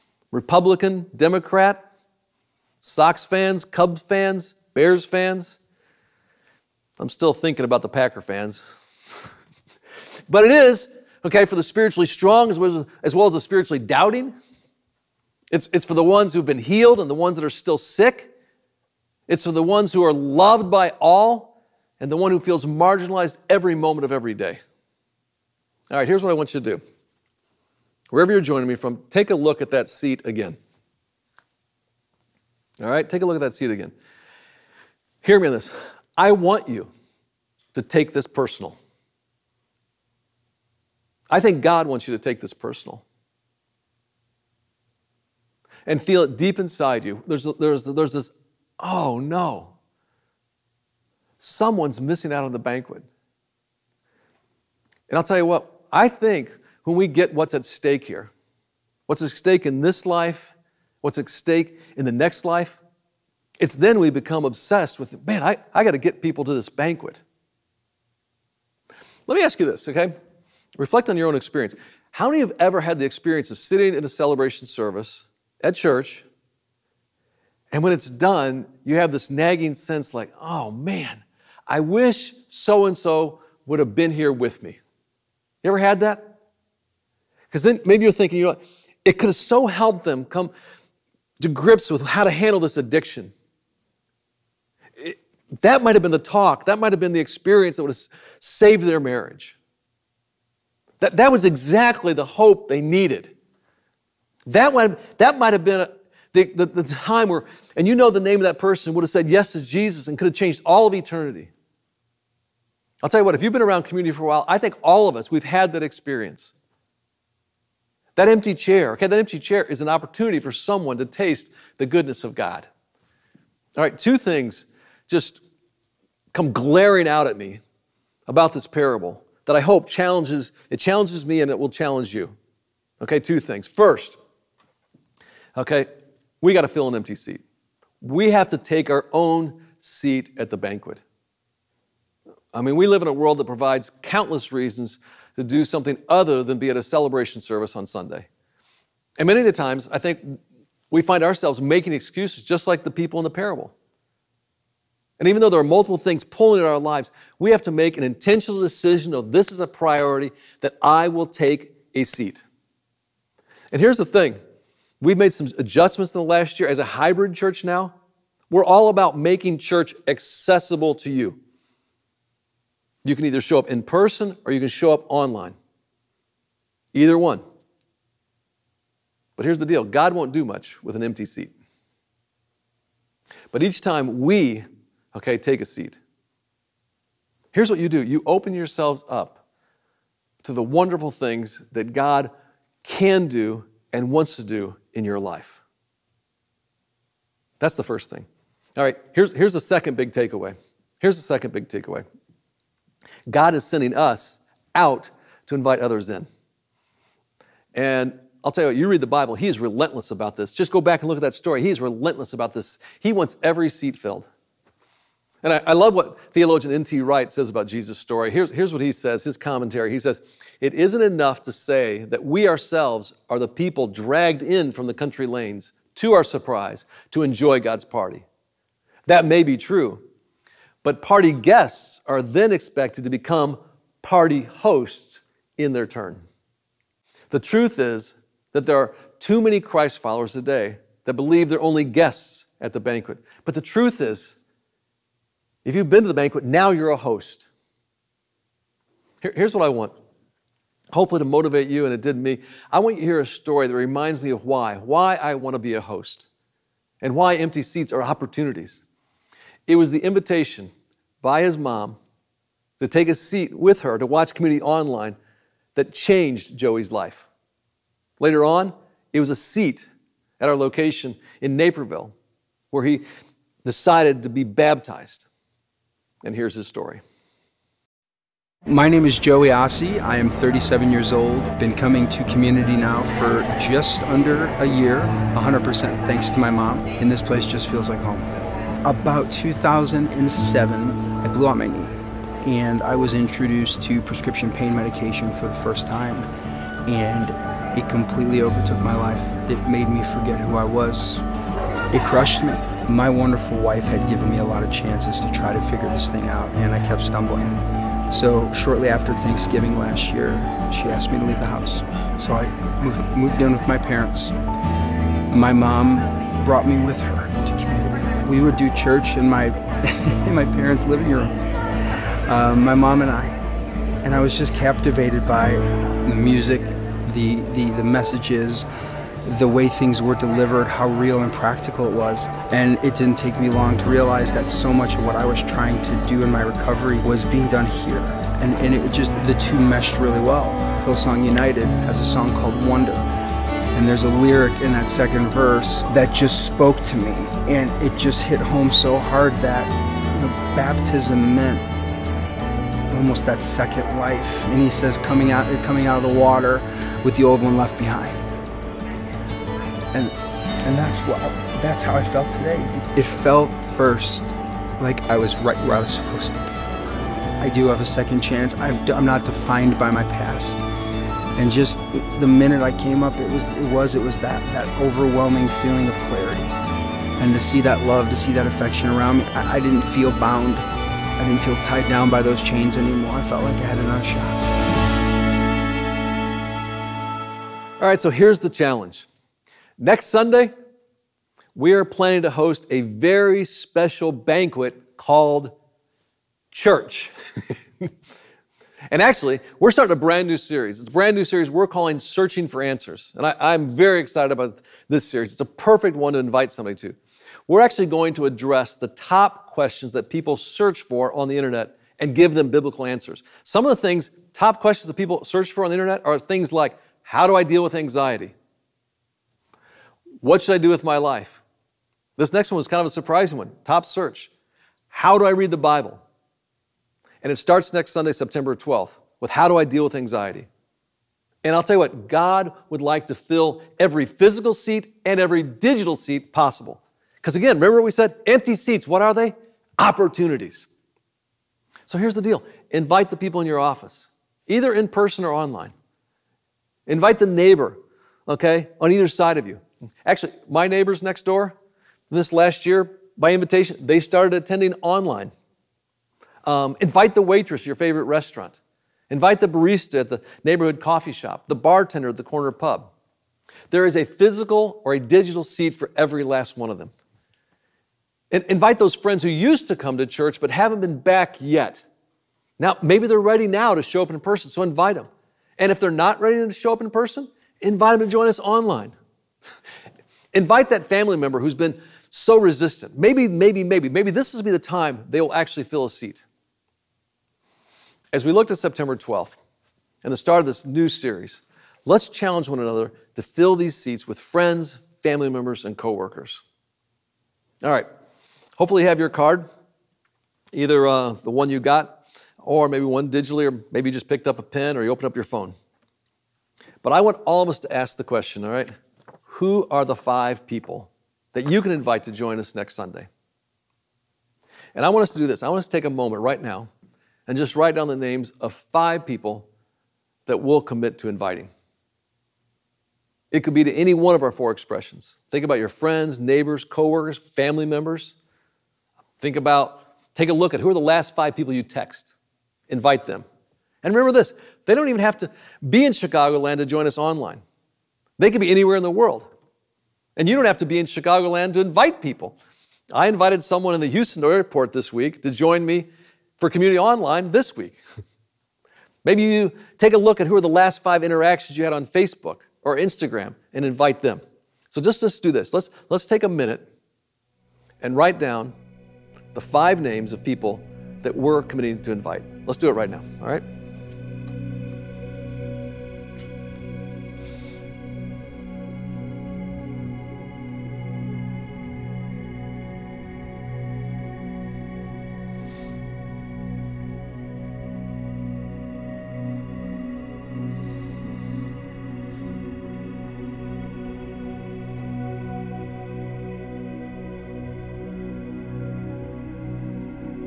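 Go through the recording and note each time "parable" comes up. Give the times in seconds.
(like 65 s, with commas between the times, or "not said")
128 s, 153 s.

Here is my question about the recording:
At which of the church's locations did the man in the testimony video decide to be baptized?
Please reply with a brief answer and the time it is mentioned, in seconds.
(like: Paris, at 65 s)
Naperville, at 271 s.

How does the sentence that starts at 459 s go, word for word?
Invite the barista at the neighborhood coffee shop, the bartender at the corner pub.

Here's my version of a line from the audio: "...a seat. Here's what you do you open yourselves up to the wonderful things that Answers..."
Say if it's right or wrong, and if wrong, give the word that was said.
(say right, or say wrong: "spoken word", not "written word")
wrong: "God", not "Answers".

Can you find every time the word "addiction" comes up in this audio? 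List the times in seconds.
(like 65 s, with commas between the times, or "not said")
92 s.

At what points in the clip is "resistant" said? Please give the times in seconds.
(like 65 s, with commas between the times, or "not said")
482 s.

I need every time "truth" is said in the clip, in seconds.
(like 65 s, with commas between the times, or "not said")
237 s, 243 s.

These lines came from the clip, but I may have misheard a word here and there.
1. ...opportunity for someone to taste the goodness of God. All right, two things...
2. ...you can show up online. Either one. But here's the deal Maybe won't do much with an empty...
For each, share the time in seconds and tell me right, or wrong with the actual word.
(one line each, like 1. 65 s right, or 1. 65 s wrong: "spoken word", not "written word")
1. 119 s right
2. 174 s wrong: "God", not "Maybe".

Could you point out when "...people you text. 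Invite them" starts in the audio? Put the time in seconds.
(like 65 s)
531 s.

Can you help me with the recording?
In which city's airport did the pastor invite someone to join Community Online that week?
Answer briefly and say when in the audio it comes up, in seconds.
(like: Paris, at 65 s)
Houston, at 543 s.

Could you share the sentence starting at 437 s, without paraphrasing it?
Because again, remember what we said?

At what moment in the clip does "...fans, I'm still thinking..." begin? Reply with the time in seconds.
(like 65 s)
5 s.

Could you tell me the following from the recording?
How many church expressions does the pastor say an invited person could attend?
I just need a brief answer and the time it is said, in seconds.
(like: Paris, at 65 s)
4, at 524 s.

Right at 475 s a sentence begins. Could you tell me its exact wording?
And if they're not ready to show up in person, invite them to join us online.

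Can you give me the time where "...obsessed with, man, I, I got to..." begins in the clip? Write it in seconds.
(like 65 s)
64 s.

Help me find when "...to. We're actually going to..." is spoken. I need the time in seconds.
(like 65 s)
406 s.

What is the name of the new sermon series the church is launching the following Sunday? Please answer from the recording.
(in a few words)
Searching for Answers.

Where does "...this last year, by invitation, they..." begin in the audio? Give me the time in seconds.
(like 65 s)
452 s.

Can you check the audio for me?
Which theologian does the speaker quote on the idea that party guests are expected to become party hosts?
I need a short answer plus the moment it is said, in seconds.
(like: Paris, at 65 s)
N.T. Wright, at 216 s.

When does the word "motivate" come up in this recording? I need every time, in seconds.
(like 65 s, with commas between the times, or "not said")
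251 s.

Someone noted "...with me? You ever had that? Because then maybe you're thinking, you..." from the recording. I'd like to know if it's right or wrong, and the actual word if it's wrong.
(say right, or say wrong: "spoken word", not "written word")
right.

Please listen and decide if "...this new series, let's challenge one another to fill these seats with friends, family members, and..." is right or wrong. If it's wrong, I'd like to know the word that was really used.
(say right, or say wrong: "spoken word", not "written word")
right.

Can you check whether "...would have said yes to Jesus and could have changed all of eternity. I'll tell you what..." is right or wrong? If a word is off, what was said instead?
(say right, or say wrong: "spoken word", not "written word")
right.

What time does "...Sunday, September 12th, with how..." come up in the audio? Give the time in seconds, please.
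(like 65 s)
427 s.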